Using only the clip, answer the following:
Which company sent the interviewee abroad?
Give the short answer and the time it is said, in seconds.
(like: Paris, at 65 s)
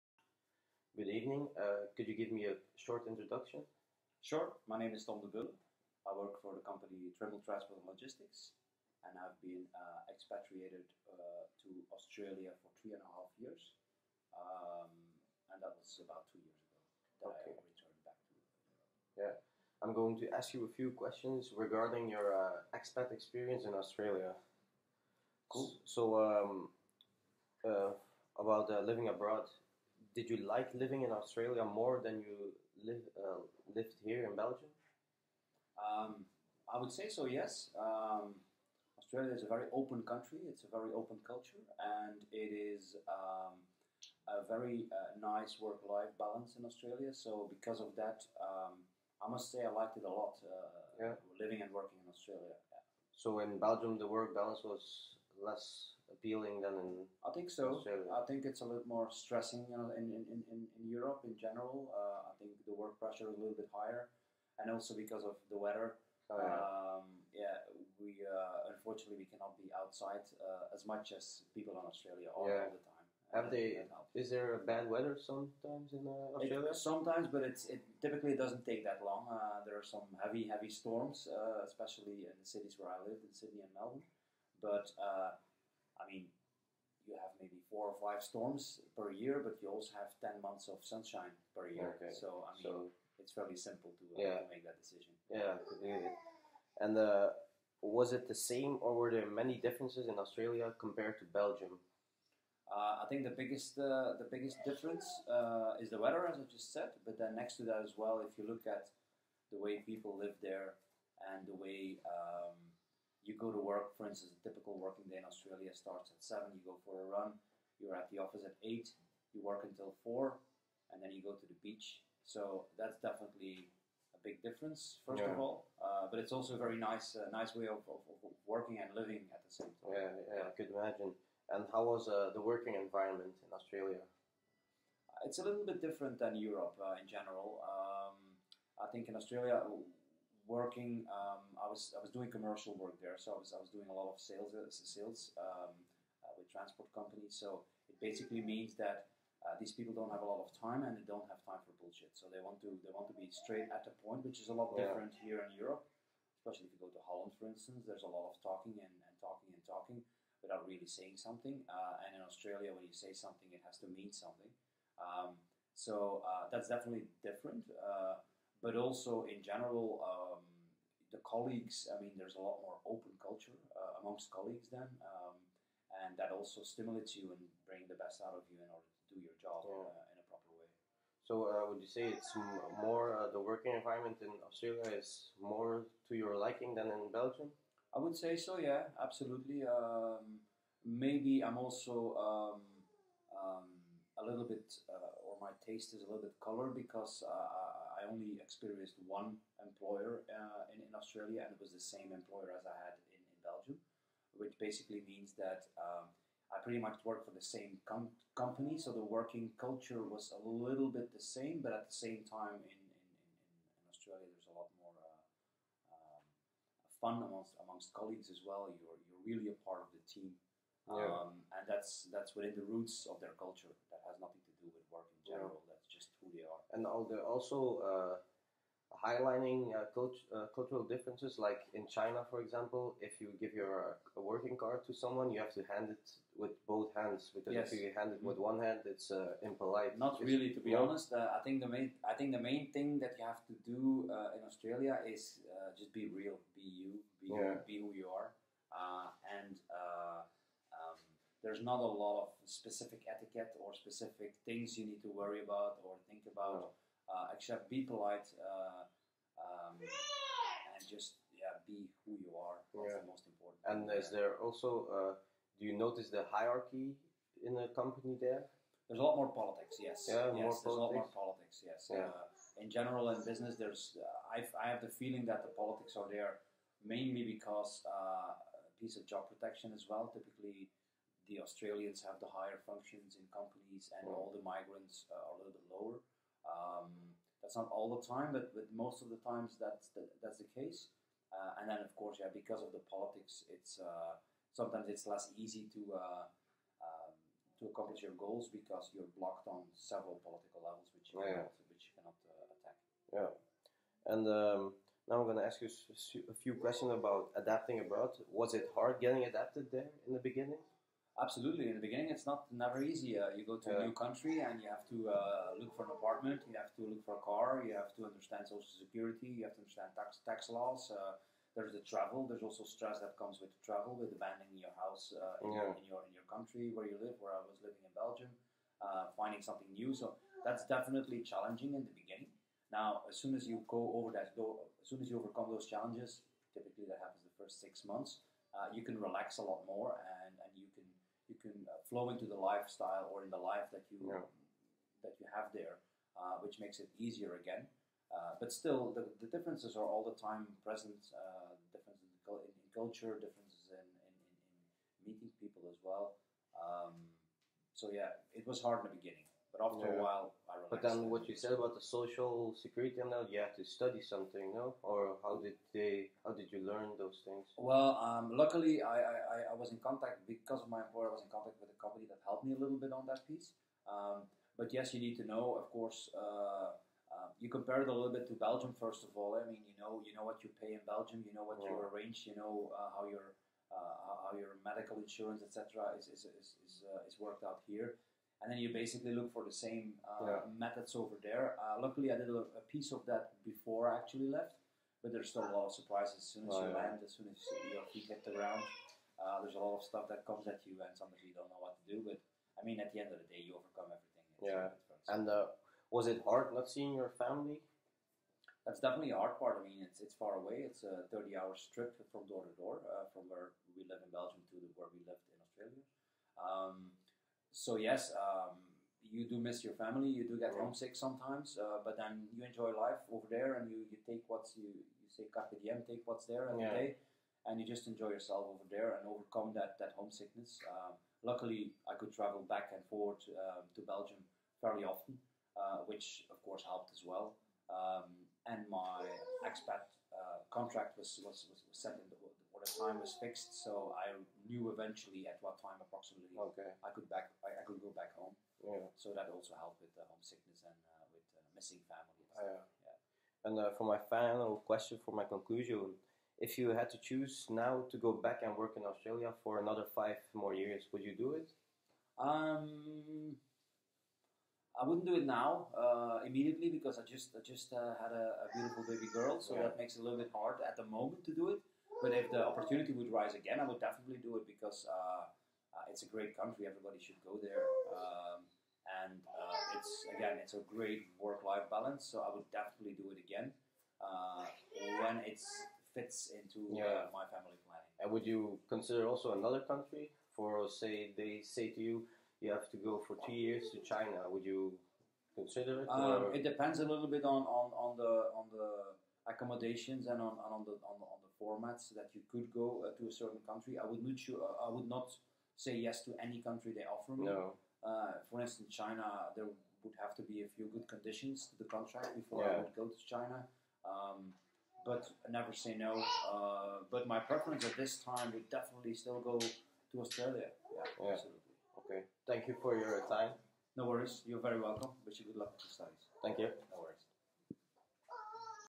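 Trimble Transport and Logistics, at 7 s.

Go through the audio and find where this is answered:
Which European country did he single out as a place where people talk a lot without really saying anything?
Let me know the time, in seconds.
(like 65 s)
157 s.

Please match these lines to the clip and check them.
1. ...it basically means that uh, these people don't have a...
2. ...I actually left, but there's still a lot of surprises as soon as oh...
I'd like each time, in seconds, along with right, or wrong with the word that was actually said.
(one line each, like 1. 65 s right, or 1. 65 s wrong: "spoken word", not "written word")
1. 147 s right
2. 393 s right.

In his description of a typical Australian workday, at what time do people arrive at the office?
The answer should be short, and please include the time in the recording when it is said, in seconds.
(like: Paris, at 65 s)
8, at 117 s.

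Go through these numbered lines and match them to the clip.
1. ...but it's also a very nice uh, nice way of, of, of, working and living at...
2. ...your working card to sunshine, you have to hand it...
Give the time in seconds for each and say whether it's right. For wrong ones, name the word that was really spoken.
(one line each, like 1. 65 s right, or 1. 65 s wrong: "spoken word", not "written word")
1. 126 s right
2. 233 s wrong: "someone", not "sunshine".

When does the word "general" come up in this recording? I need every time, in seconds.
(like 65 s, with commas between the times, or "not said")
61 s, 137 s, 169 s, 225 s, 272 s.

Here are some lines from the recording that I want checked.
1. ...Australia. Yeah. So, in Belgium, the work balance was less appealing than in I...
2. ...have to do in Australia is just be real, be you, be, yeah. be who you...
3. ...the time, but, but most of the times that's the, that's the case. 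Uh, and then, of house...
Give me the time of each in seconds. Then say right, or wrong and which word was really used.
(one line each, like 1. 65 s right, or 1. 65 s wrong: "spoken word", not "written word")
1. 52 s right
2. 243 s right
3. 287 s wrong: "course", not "house".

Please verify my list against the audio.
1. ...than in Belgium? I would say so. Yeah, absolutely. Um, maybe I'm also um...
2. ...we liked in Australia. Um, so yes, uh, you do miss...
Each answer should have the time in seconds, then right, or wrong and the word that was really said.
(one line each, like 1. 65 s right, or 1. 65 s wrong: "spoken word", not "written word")
1. 186 s right
2. 414 s wrong: "lived", not "liked".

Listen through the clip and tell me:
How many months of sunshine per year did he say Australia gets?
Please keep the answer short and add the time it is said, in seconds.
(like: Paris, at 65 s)
10, at 90 s.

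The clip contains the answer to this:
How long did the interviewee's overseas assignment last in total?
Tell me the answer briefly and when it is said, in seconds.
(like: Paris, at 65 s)
3.5 years, at 12 s.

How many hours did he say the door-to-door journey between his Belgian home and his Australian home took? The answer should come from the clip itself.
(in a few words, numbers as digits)
30.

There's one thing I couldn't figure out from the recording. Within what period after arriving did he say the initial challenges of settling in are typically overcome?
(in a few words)
The first 6 months.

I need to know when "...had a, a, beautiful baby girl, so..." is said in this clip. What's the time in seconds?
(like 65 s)
467 s.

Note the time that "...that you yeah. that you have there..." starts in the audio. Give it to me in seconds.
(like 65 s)
343 s.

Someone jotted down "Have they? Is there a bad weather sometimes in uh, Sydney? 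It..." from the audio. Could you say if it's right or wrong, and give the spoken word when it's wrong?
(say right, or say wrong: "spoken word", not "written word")
wrong: "Australia", not "Sydney".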